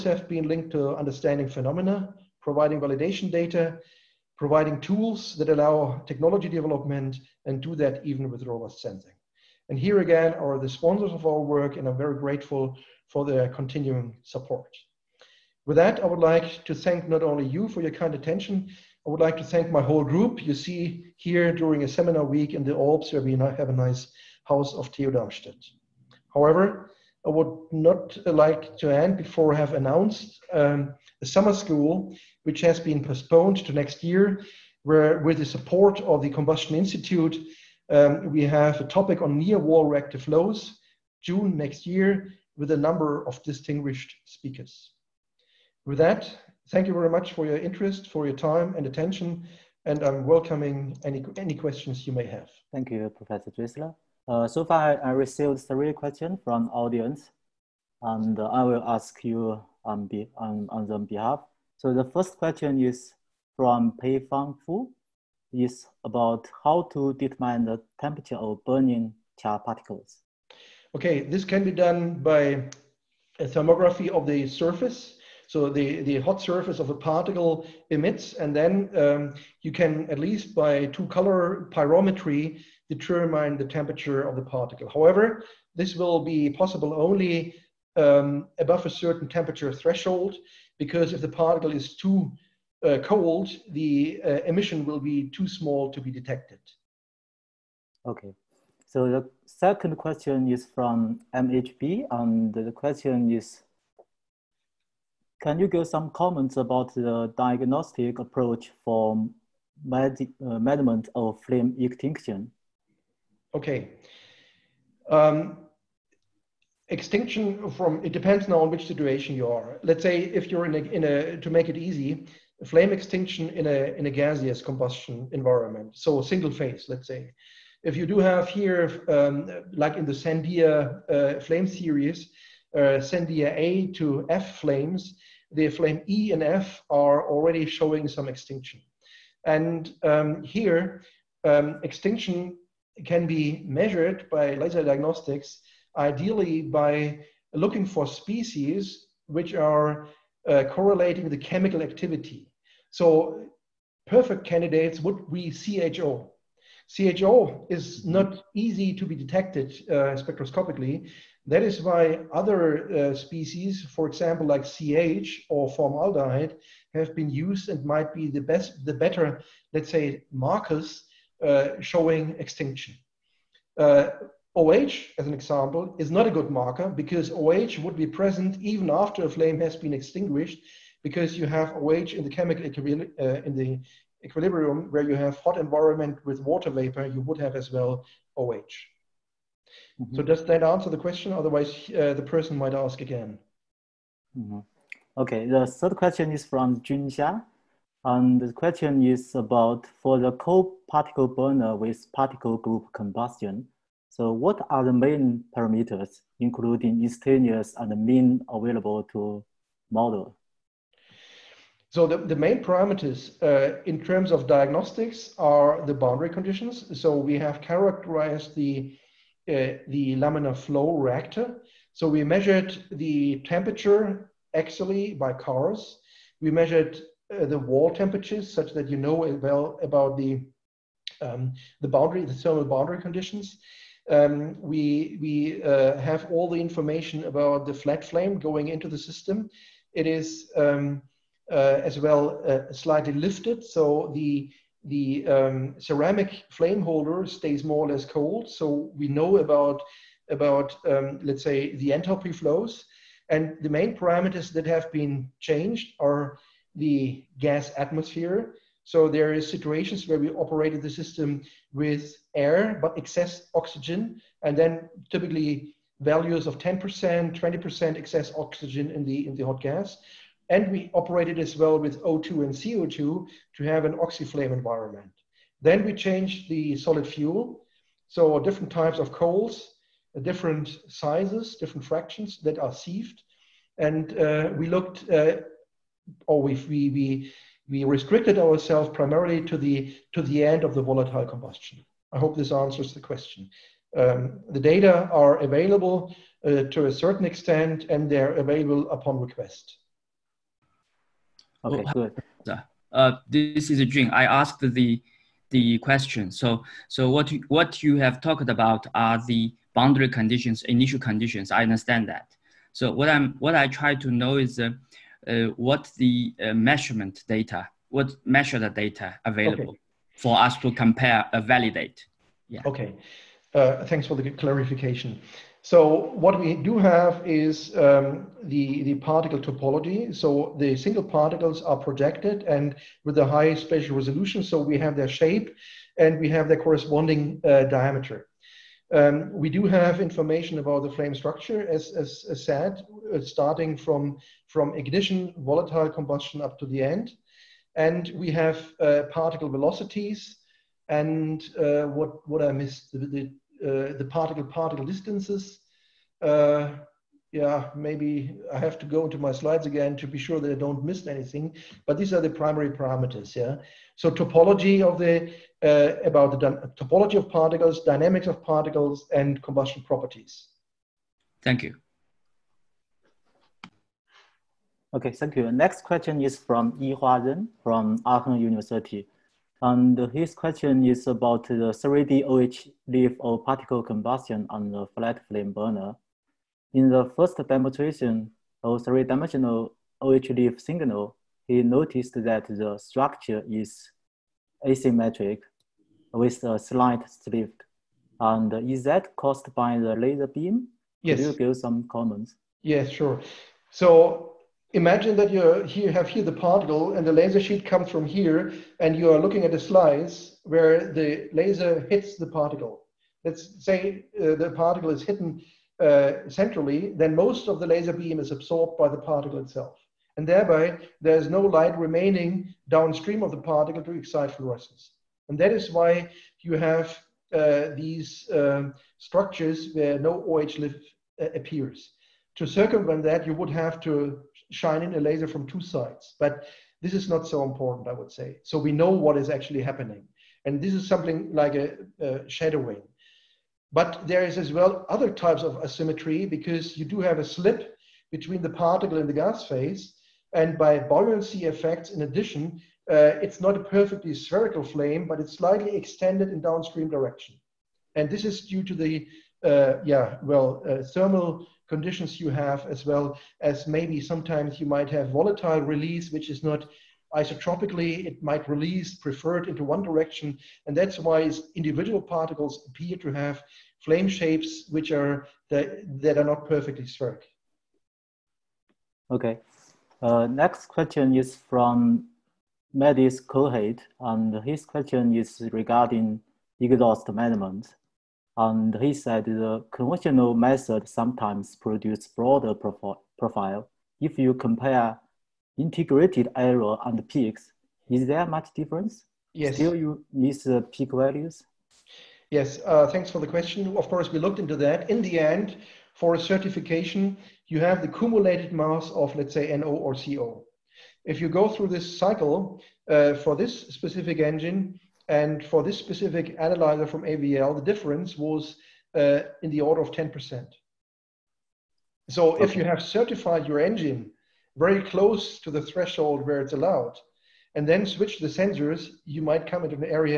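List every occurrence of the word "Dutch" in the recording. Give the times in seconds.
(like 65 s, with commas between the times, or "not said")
not said.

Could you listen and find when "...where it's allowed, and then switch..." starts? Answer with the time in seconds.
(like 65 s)
526 s.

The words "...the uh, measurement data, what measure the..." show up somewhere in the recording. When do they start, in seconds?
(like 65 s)
315 s.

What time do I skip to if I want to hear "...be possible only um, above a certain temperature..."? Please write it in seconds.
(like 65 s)
86 s.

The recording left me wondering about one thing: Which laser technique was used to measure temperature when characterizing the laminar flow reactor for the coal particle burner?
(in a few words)
CARS.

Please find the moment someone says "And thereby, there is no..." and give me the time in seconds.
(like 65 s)
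420 s.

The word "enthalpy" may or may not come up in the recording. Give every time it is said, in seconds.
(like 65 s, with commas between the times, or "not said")
251 s.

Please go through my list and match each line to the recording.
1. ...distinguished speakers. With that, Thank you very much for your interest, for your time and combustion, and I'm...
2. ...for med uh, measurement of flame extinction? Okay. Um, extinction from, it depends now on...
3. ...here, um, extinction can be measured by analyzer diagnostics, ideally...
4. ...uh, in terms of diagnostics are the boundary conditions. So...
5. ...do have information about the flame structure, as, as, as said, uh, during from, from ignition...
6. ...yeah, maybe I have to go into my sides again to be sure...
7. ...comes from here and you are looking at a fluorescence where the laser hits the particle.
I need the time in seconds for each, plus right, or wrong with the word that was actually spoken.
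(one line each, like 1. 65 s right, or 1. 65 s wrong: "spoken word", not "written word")
1. 43 s wrong: "attention", not "combustion"
2. 108 s right
3. 140 s wrong: "laser", not "analyzer"
4. 213 s right
5. 339 s wrong: "starting", not "during"
6. 357 s wrong: "slides", not "sides"
7. 407 s wrong: "slice", not "fluorescence".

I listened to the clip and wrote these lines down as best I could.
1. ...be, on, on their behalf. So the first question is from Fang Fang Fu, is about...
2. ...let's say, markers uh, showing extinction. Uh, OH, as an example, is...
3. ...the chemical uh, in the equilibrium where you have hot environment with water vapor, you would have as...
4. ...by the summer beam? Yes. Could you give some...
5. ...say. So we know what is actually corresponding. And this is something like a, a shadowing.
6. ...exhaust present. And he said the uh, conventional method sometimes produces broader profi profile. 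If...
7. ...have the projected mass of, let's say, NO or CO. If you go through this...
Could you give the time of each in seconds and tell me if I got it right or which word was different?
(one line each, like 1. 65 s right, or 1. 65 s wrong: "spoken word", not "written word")
1. 60 s wrong: "Pei", not "Fang"
2. 169 s right
3. 182 s right
4. 399 s wrong: "laser", not "summer"
5. 438 s wrong: "happening", not "corresponding"
6. 486 s wrong: "management", not "present"
7. 507 s wrong: "cumulated", not "projected".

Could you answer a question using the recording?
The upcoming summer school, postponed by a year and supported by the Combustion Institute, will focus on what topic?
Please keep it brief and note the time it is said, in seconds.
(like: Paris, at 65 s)
Near wall reactive flows, at 39 s.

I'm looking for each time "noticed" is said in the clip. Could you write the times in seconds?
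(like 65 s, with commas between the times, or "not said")
391 s.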